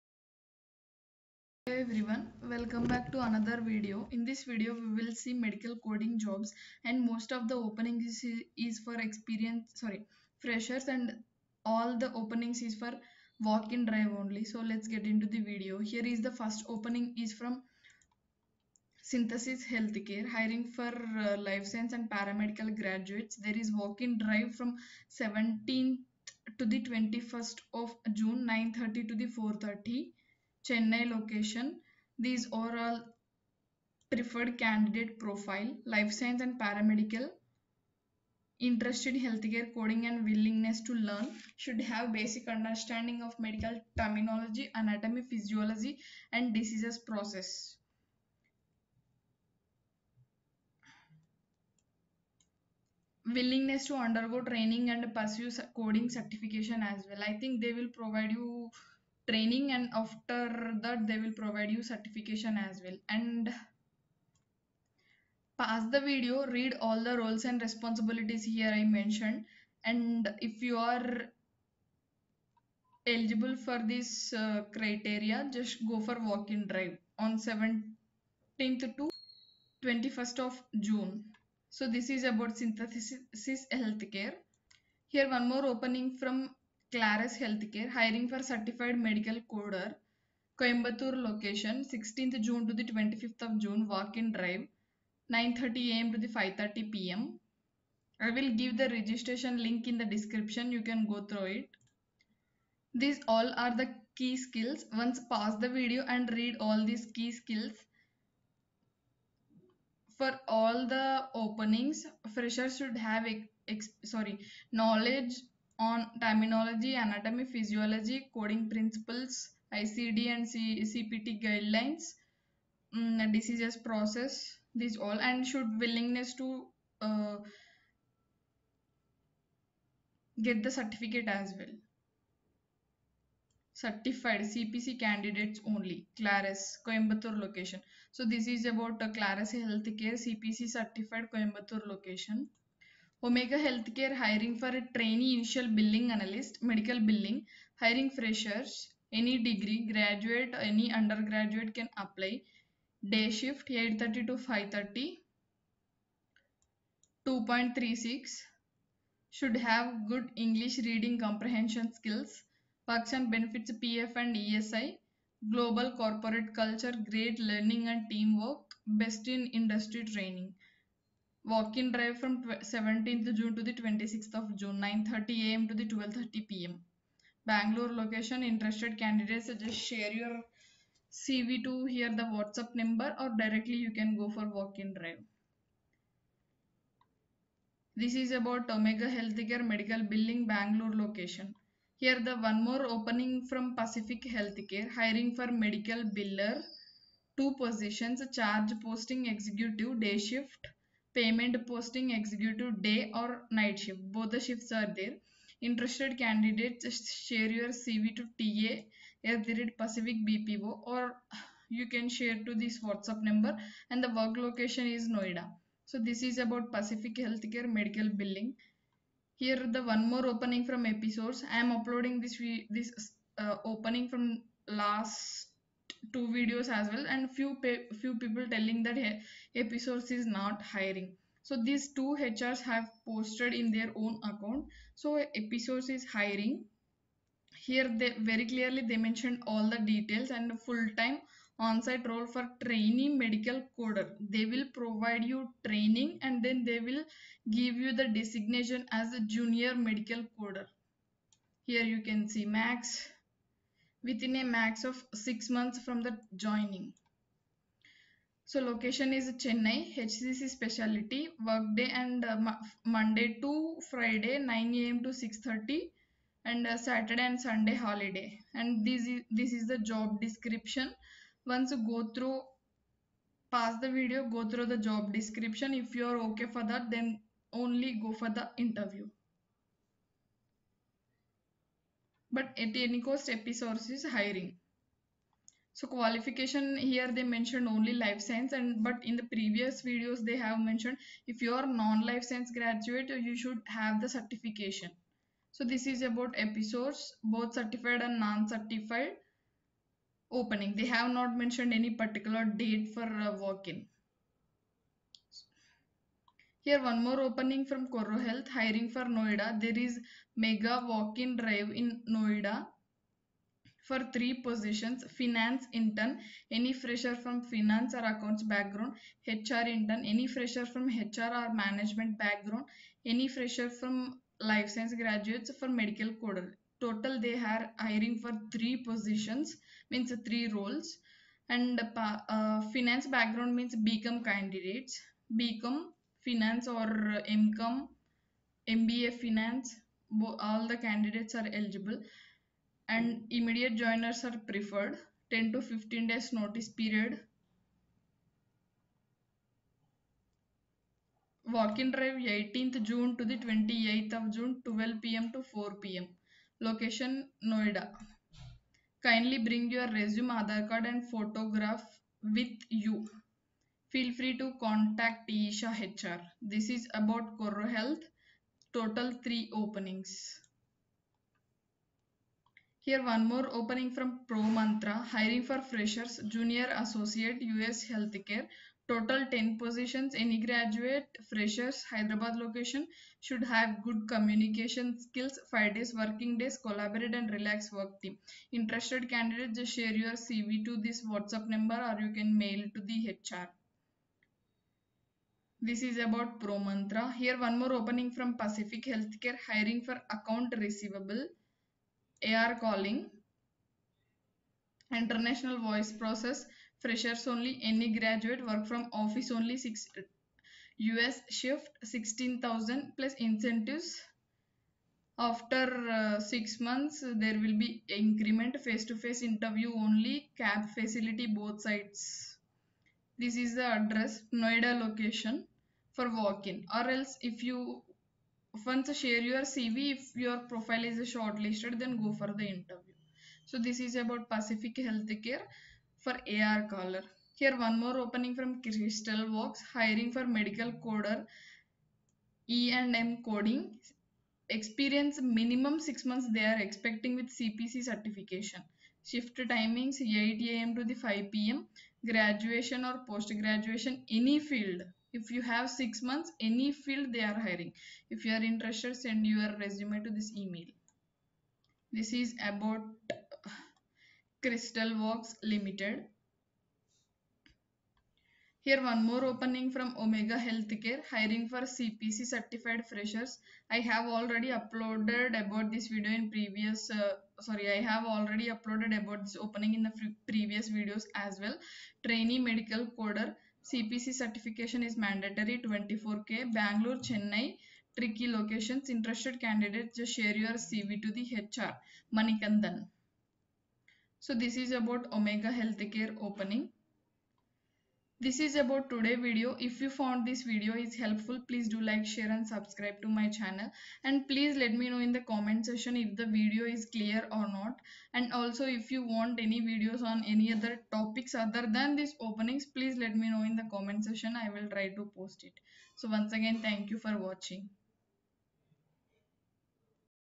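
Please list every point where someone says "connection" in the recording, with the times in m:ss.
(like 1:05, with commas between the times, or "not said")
not said.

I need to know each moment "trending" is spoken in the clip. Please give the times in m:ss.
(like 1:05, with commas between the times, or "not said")
not said.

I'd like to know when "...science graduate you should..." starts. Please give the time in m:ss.
4:52.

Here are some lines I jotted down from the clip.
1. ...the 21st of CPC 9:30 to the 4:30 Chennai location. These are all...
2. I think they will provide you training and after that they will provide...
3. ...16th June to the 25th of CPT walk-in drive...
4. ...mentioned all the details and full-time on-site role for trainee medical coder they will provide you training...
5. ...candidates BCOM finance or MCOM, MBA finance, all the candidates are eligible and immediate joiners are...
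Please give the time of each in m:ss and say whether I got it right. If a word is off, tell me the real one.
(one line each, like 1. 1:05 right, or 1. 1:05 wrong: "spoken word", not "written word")
1. 0:26 wrong: "June", not "CPC"
2. 0:57 right
3. 1:31 wrong: "June", not "CPT"
4. 3:58 right
5. 5:34 right.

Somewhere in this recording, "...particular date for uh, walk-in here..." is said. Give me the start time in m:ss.
5:01.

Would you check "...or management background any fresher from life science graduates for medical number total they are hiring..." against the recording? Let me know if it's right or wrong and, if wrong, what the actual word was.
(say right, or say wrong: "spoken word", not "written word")
wrong: "coder", not "number".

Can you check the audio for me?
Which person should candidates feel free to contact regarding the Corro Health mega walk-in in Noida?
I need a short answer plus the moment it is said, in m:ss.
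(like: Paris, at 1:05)
Isha, at 6:05.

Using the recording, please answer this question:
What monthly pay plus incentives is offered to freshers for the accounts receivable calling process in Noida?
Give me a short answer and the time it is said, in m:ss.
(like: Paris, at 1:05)
16,000, at 6:51.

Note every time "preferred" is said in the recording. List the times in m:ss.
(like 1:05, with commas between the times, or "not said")
0:34, 5:44.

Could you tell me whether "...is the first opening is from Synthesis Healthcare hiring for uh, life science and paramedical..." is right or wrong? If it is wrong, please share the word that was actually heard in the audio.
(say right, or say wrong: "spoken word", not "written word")
right.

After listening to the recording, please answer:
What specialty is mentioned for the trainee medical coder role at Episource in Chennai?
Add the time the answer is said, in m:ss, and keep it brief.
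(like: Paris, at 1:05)
HCC, at 4:19.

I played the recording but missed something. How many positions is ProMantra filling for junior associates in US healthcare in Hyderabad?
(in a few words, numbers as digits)
10.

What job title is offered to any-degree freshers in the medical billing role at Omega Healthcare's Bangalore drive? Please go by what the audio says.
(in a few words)
Trainee initial billing analyst.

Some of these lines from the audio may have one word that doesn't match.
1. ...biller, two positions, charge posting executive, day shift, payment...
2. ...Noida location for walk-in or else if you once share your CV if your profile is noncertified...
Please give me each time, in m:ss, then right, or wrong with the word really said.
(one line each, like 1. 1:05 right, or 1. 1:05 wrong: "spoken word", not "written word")
1. 3:16 right
2. 7:04 wrong: "shortlisted", not "noncertified".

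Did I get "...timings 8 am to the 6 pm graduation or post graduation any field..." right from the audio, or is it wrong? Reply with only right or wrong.
wrong.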